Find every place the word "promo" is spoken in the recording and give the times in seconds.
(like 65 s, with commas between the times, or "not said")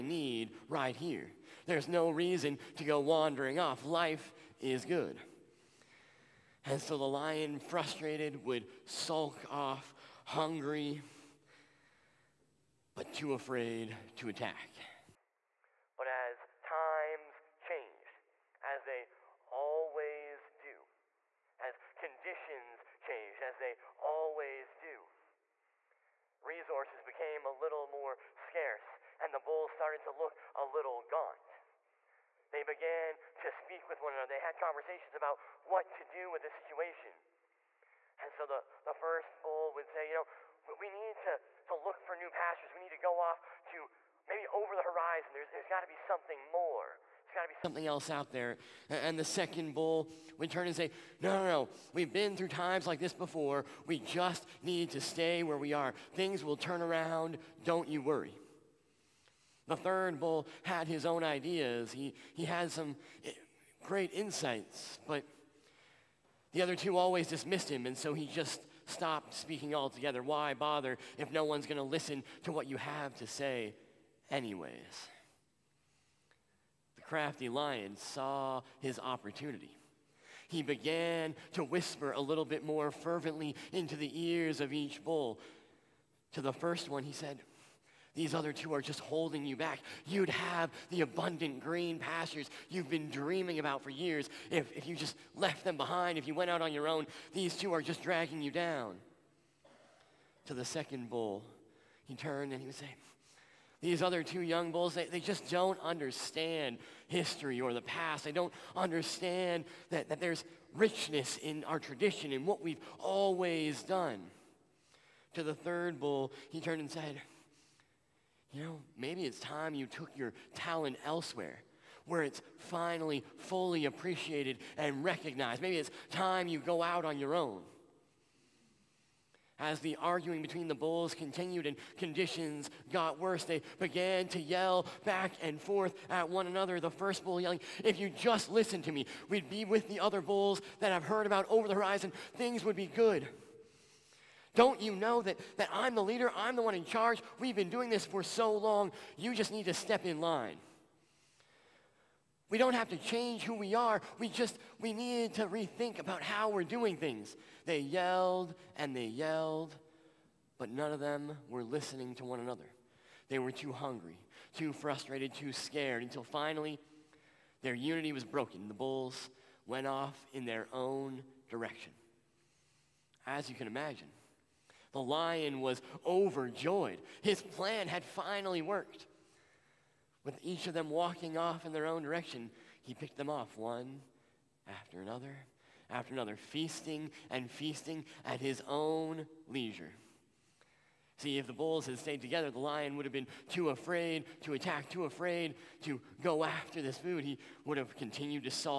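not said.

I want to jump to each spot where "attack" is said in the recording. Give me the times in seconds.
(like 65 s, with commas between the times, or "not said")
14 s, 194 s.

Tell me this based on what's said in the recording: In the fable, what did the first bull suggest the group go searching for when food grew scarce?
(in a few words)
New pastures.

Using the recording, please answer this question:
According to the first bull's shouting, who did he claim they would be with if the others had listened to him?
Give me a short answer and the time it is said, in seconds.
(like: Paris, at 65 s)
The other bulls, at 139 s.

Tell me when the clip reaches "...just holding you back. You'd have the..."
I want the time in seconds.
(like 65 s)
88 s.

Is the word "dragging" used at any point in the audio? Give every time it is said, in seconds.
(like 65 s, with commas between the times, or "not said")
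98 s.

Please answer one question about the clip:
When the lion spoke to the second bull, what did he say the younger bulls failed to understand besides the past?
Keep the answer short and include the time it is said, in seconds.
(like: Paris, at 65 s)
History, at 107 s.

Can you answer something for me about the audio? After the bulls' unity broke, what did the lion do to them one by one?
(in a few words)
Picked them off.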